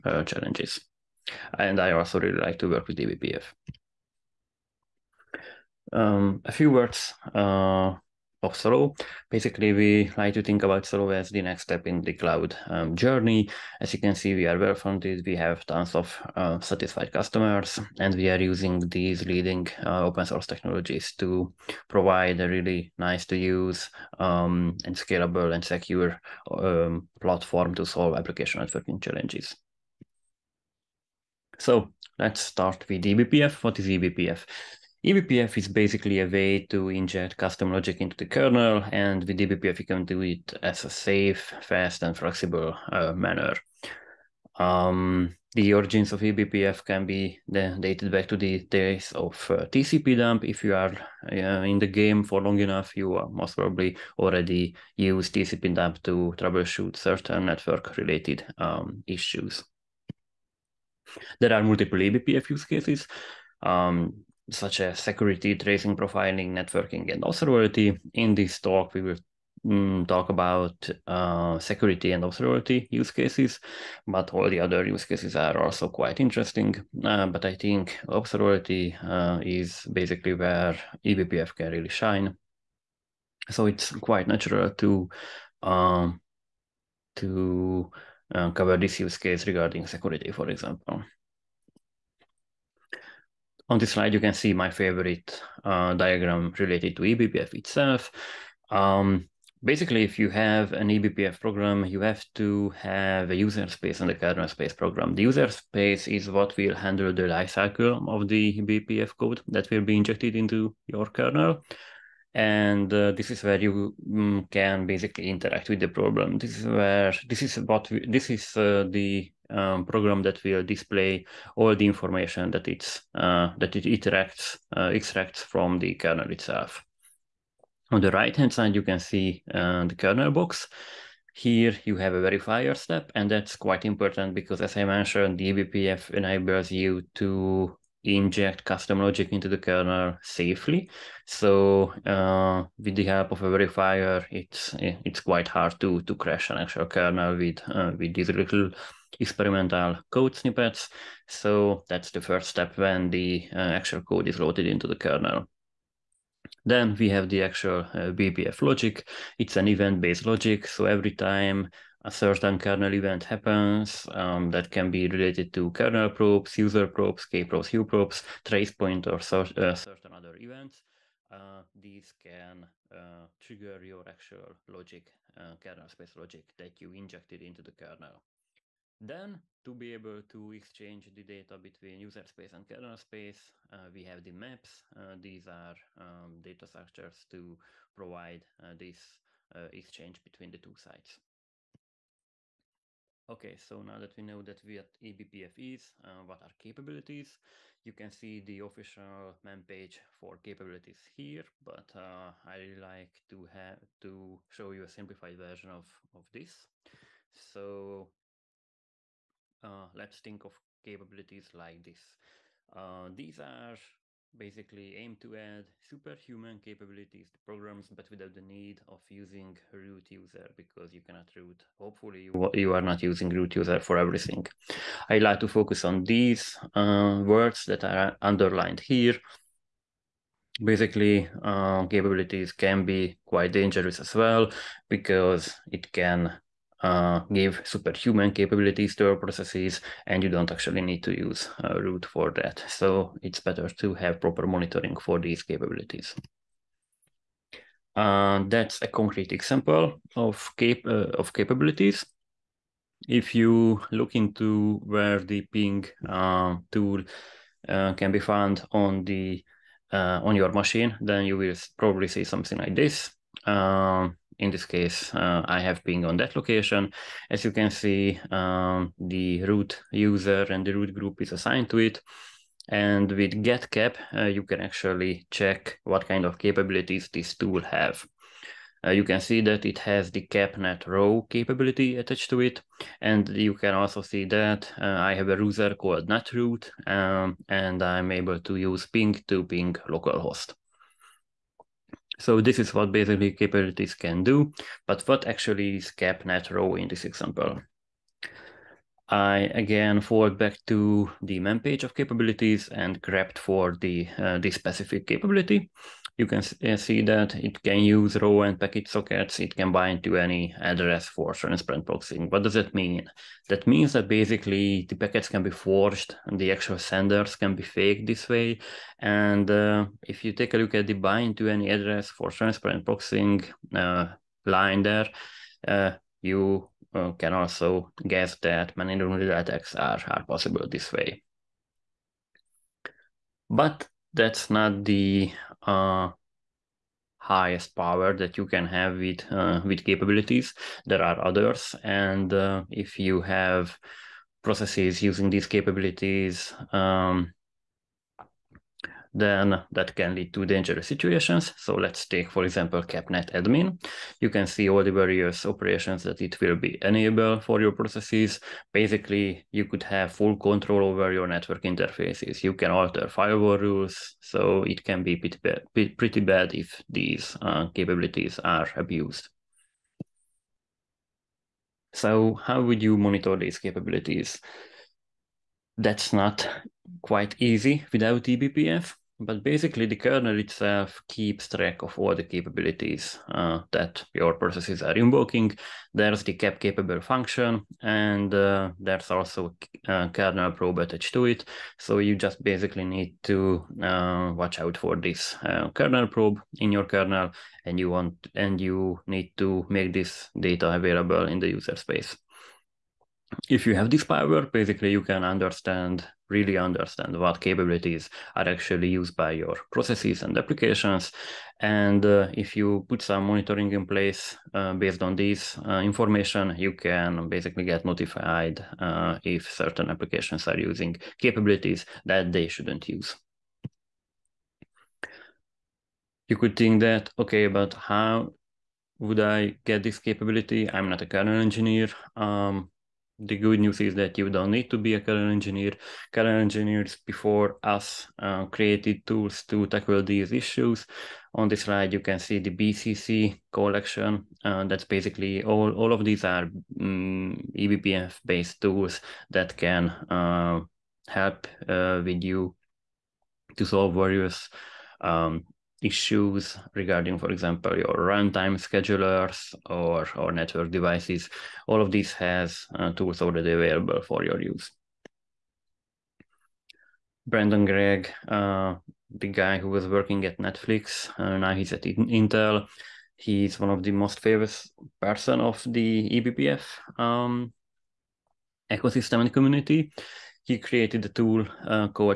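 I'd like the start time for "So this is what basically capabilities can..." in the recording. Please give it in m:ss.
4:52.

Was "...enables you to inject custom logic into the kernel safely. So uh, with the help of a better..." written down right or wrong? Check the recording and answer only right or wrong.
wrong.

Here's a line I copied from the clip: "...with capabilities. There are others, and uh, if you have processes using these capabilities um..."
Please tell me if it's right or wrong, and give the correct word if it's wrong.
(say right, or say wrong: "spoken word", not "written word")
right.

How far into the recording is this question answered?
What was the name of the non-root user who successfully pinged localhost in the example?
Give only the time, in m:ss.
4:46.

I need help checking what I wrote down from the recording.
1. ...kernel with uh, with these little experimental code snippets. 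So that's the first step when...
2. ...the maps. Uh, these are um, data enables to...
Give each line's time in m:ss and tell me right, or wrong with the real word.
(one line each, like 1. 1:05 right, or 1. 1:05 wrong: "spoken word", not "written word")
1. 2:26 right
2. 3:04 wrong: "structures", not "enables".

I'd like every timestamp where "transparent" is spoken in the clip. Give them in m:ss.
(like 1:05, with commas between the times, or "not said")
5:11, 5:22.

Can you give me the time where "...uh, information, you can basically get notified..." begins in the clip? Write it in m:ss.
6:55.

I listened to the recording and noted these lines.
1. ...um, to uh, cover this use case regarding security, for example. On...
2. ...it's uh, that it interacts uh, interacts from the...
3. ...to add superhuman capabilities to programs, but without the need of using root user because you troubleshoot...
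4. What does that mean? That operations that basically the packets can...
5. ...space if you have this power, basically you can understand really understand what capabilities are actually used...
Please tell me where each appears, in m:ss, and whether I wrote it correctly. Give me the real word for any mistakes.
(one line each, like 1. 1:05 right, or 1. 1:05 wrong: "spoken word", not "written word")
1. 1:25 right
2. 2:02 wrong: "extracts", not "interacts"
3. 3:35 wrong: "cannot", not "troubleshoot"
4. 5:12 wrong: "means", not "operations"
5. 6:41 right.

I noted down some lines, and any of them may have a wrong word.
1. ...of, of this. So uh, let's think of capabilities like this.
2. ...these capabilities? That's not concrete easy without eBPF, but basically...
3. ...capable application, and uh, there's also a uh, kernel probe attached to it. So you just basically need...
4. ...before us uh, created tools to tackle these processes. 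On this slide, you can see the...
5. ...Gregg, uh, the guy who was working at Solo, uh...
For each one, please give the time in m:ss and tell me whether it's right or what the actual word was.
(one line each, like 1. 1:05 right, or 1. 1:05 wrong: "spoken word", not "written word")
1. 3:25 right
2. 6:13 wrong: "quite", not "concrete"
3. 6:26 wrong: "function", not "application"
4. 7:17 wrong: "issues", not "processes"
5. 7:47 wrong: "Netflix", not "Solo".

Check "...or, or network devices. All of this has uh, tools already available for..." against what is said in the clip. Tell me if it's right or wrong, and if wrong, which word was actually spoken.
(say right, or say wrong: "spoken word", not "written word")
right.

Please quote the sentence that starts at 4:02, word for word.
So it's better to have proper monitoring for these capabilities.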